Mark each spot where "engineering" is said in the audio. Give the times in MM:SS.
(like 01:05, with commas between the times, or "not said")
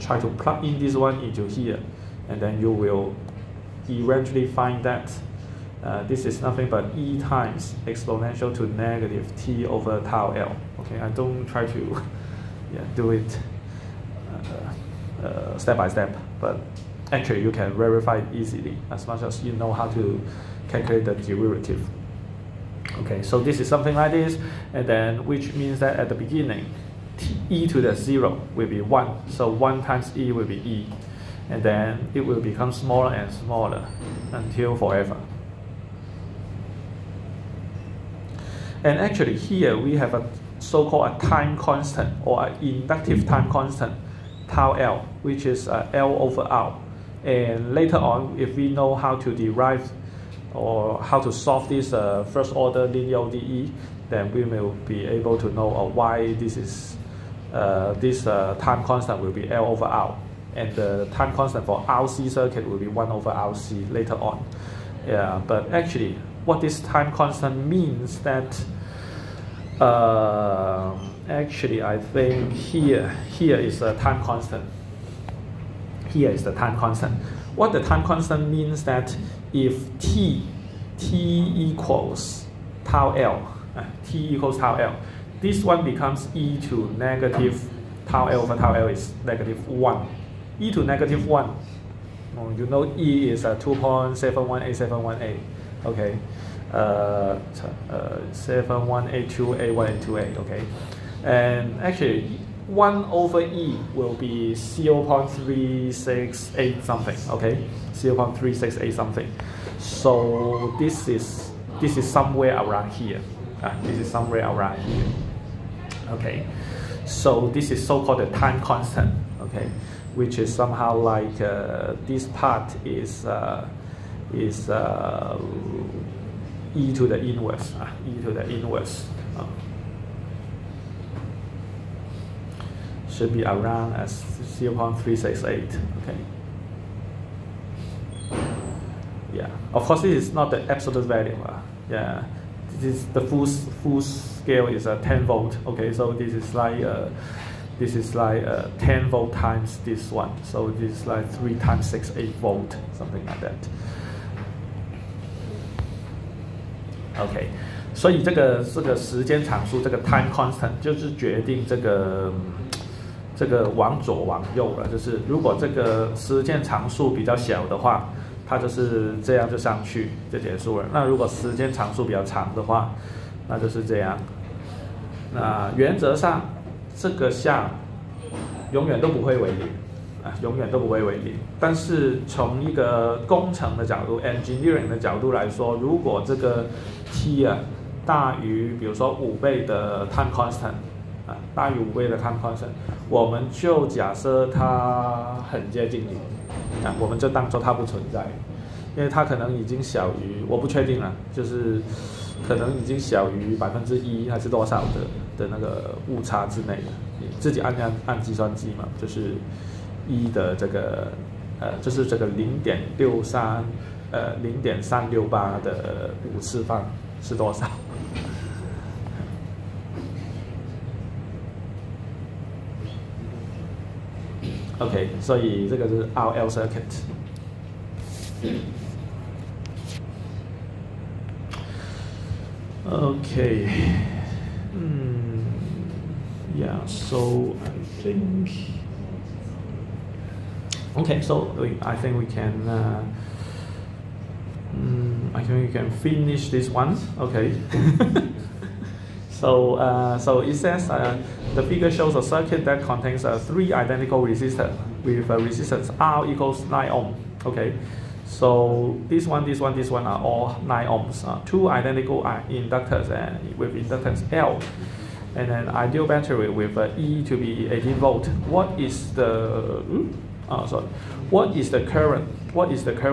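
03:04.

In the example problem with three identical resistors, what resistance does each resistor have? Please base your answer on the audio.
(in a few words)
9 ohms.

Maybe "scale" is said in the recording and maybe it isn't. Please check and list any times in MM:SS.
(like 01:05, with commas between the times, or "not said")
02:24.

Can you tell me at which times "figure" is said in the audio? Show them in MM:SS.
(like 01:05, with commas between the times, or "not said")
04:11.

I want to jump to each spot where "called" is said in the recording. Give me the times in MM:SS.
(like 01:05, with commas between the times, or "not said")
00:40, 01:57.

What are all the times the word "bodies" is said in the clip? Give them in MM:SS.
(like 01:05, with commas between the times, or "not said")
not said.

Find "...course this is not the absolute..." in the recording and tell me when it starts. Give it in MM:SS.
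02:19.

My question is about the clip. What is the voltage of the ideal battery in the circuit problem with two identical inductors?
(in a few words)
18 volts.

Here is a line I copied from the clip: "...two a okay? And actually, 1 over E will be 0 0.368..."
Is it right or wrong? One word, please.
right.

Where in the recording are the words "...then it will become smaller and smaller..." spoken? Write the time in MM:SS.
00:31.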